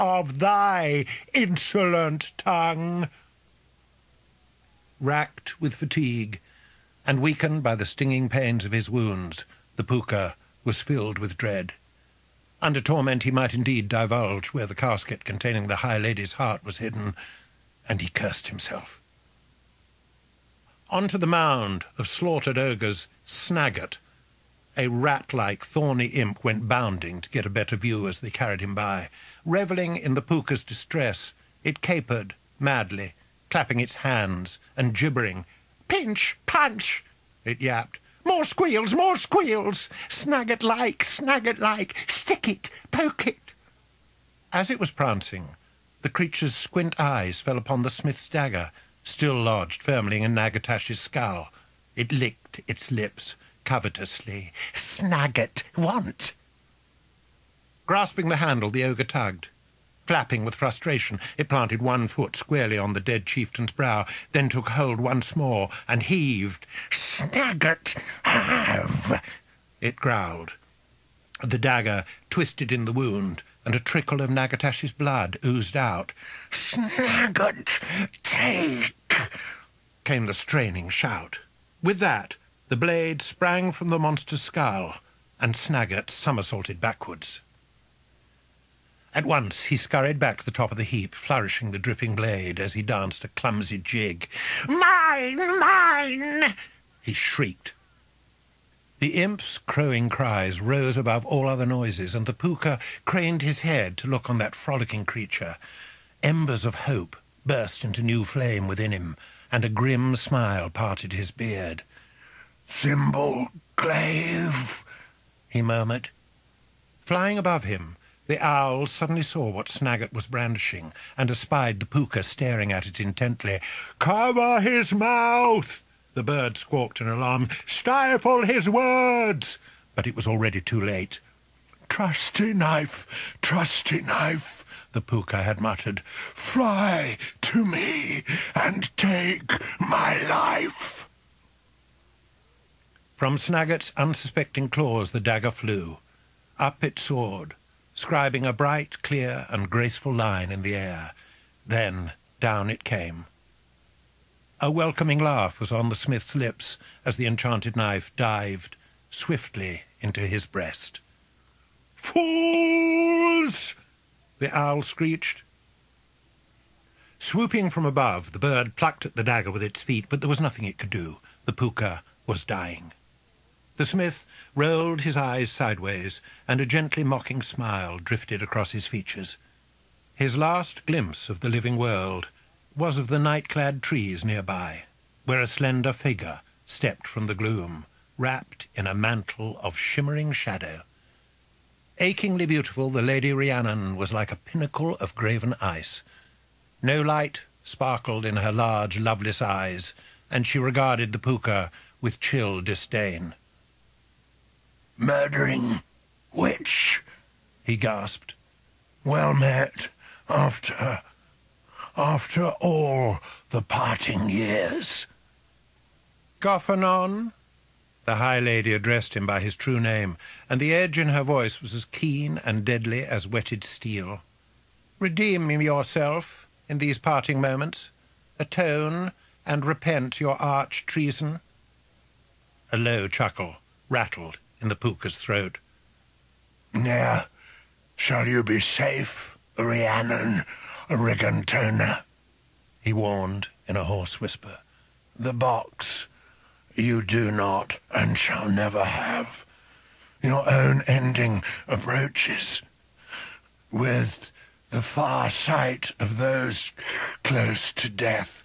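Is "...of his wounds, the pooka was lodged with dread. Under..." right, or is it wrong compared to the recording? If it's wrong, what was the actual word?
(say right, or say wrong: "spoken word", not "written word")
wrong: "filled", not "lodged".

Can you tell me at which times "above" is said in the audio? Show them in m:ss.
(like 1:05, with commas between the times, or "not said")
1:40, 1:57, 2:47.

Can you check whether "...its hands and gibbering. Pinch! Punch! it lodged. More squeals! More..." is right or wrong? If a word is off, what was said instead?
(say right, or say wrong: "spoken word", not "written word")
wrong: "yapped", not "lodged".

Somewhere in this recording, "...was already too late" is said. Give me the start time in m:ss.
2:10.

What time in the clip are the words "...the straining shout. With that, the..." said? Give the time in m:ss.
1:20.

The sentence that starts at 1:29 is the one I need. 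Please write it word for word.
At once he scurried back to the top of the heap, flourishing the dripping blade as he danced a clumsy jig.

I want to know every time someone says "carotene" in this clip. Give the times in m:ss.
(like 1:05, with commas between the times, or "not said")
not said.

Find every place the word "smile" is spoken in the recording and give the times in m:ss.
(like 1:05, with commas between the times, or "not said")
1:50, 2:57.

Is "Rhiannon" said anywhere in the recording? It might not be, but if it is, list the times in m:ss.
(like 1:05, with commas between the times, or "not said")
3:13, 3:59.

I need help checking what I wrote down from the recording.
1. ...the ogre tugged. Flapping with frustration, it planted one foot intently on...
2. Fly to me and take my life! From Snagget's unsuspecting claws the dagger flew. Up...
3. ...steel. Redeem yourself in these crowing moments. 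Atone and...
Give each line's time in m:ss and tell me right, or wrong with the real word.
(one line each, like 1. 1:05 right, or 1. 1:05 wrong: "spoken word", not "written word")
1. 0:58 wrong: "squarely", not "intently"
2. 2:16 right
3. 3:43 wrong: "parting", not "crowing".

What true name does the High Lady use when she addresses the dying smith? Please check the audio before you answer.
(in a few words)
Goffanon.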